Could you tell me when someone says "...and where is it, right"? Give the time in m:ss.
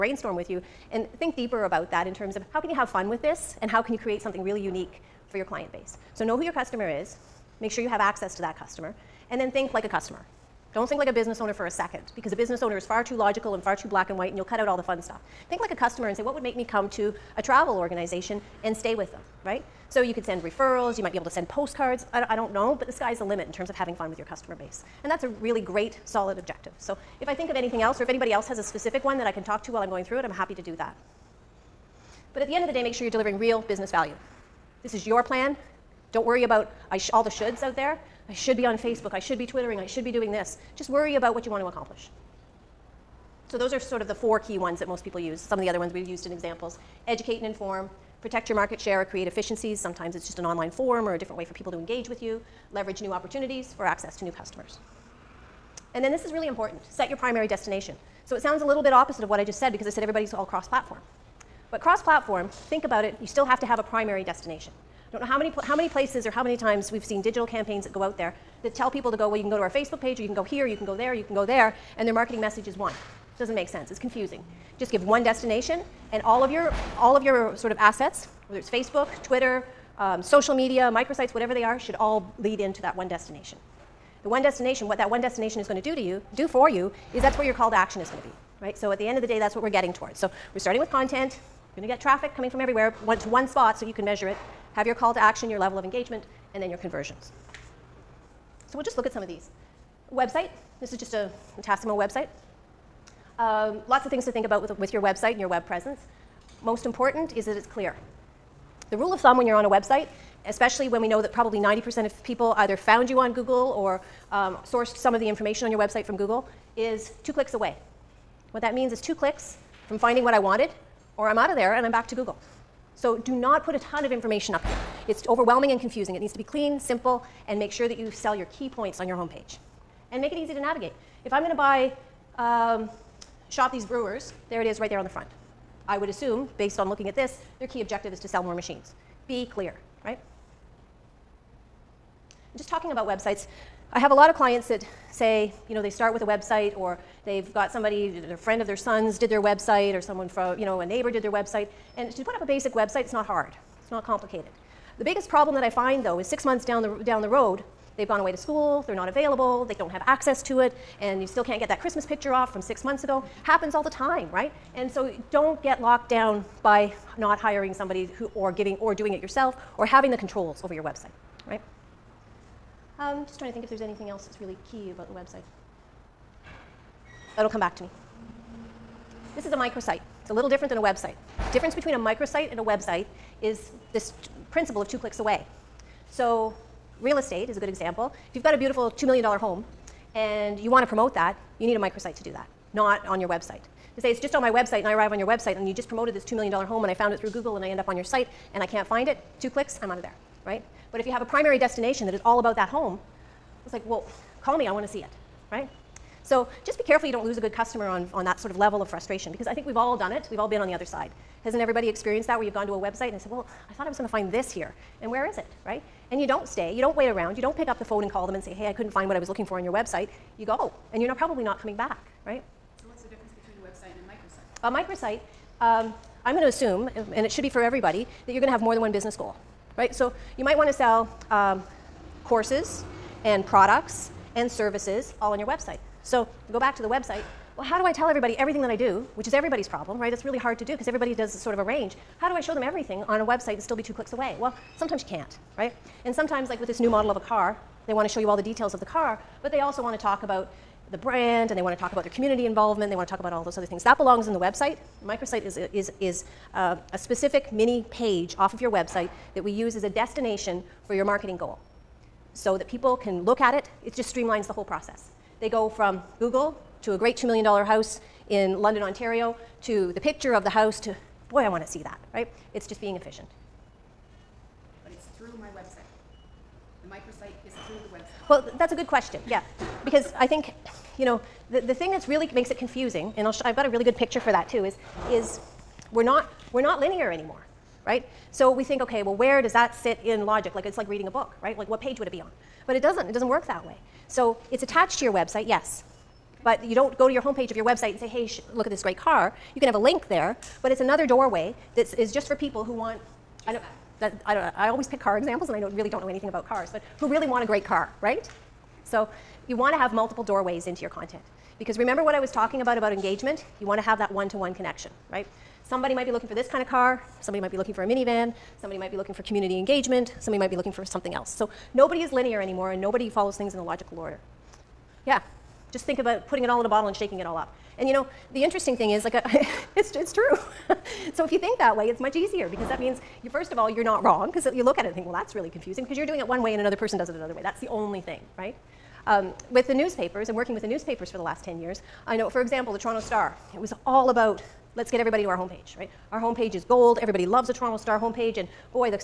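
3:35.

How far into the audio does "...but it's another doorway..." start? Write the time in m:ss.
5:00.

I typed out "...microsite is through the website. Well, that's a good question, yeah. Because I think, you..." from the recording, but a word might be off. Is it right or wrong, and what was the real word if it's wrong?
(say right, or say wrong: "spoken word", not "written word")
right.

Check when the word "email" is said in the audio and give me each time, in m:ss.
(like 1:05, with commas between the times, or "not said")
not said.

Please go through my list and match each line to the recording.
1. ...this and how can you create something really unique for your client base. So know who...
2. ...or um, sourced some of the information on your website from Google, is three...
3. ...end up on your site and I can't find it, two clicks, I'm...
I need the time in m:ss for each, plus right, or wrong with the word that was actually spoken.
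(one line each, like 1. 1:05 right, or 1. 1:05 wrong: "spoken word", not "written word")
1. 0:03 right
2. 1:53 wrong: "two", not "three"
3. 3:17 right.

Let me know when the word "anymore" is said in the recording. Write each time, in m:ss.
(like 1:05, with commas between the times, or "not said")
4:47, 5:22.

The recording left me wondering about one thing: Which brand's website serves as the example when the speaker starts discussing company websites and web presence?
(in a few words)
Tassimo.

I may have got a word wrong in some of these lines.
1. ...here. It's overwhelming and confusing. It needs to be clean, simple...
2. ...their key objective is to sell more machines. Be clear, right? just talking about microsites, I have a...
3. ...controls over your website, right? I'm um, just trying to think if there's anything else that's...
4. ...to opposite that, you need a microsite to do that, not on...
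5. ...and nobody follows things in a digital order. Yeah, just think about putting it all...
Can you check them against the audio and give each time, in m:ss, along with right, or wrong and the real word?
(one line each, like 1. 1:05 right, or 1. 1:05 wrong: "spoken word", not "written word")
1. 2:04 right
2. 2:17 wrong: "websites", not "microsites"
3. 2:50 right
4. 3:10 wrong: "promote", not "opposite"
5. 5:22 wrong: "logical", not "digital".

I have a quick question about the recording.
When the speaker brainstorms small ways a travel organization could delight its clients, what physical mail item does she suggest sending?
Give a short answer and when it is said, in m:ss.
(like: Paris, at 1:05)
Postcards, at 0:21.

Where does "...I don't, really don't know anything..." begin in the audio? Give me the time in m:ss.
5:05.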